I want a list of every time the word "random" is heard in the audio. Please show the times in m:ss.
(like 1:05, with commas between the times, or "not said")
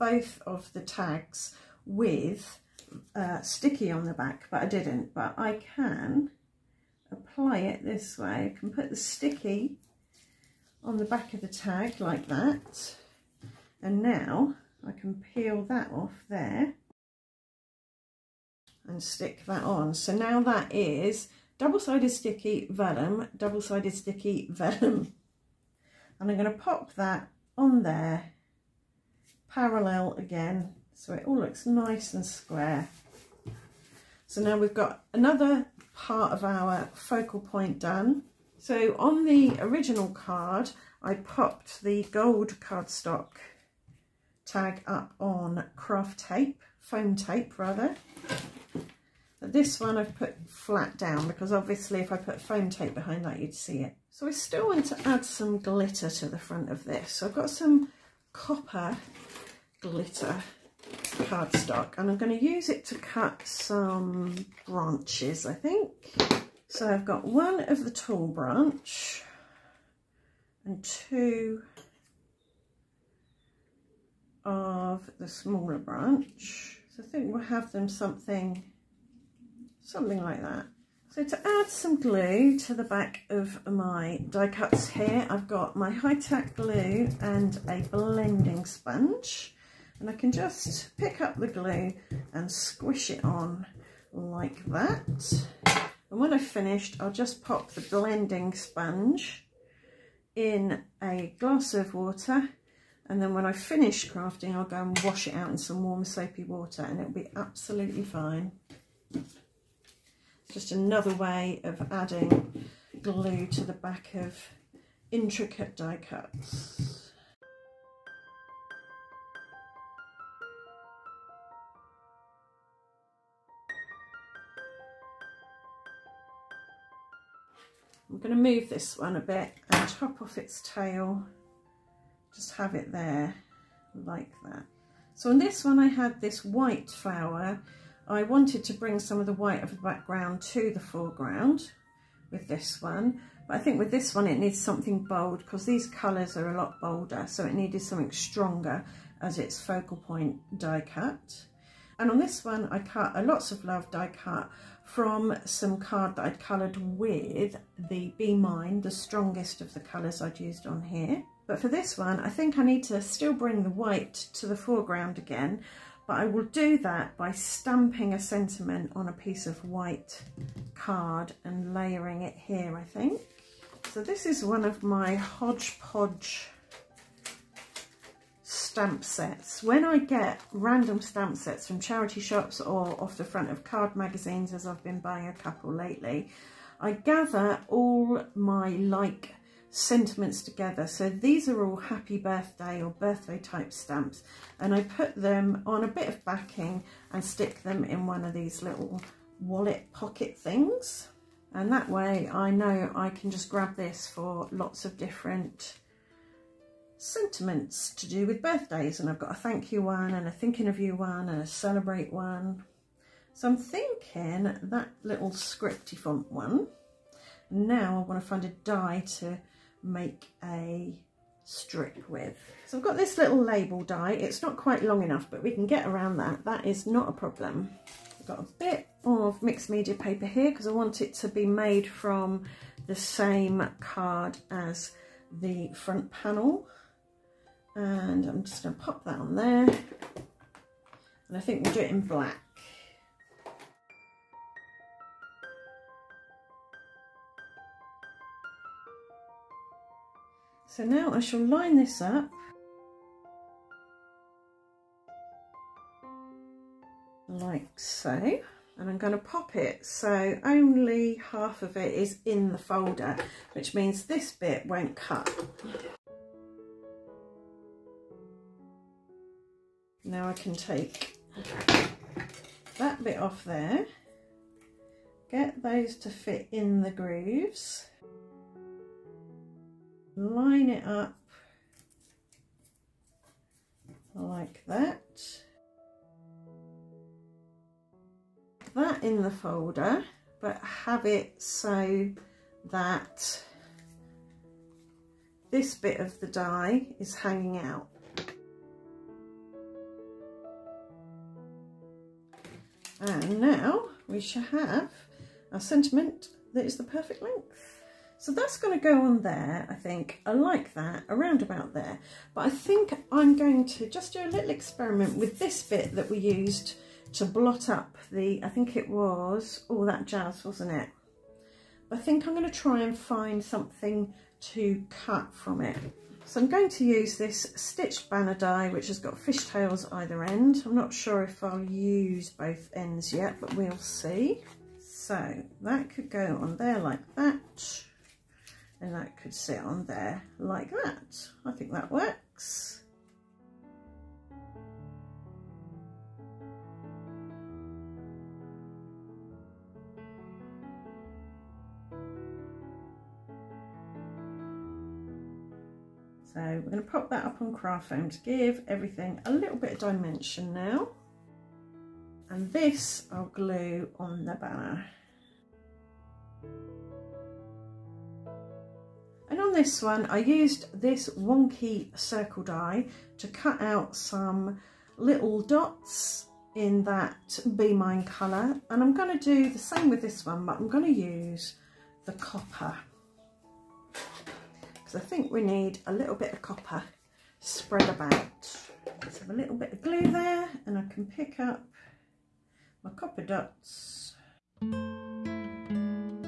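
3:00.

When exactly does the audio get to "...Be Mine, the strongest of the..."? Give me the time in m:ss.
2:38.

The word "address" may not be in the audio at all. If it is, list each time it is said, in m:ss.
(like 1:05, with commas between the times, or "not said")
not said.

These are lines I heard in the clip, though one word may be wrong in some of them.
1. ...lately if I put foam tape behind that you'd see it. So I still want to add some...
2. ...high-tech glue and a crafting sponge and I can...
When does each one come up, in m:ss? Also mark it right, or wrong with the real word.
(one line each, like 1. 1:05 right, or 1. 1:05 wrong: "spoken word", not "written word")
1. 0:51 wrong: "obviously", not "lately"
2. 1:25 wrong: "blending", not "crafting".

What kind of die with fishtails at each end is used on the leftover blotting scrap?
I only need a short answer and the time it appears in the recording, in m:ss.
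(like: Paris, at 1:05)
Stitched banner die, at 5:27.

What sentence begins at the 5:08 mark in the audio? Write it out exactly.
So that's going to go on there, I think.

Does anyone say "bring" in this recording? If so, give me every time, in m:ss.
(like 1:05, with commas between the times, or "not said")
2:18, 2:43.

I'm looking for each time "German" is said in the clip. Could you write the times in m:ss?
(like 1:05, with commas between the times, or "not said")
not said.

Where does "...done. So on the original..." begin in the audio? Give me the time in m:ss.
0:37.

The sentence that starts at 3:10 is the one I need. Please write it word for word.
So these are all happy birthday or birthday type stamps.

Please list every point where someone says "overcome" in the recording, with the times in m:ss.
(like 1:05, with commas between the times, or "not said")
not said.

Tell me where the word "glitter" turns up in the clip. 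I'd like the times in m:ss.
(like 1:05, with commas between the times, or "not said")
0:55, 0:59.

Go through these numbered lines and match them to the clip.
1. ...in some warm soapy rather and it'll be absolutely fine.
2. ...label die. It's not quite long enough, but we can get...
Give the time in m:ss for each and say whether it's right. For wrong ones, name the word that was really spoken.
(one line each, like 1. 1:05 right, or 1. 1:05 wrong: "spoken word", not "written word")
1. 1:45 wrong: "water", not "rather"
2. 3:43 right.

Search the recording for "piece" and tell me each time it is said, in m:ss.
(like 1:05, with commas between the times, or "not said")
2:49.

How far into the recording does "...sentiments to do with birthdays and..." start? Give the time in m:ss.
3:27.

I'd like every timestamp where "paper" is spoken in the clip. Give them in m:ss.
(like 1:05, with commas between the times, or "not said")
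3:49.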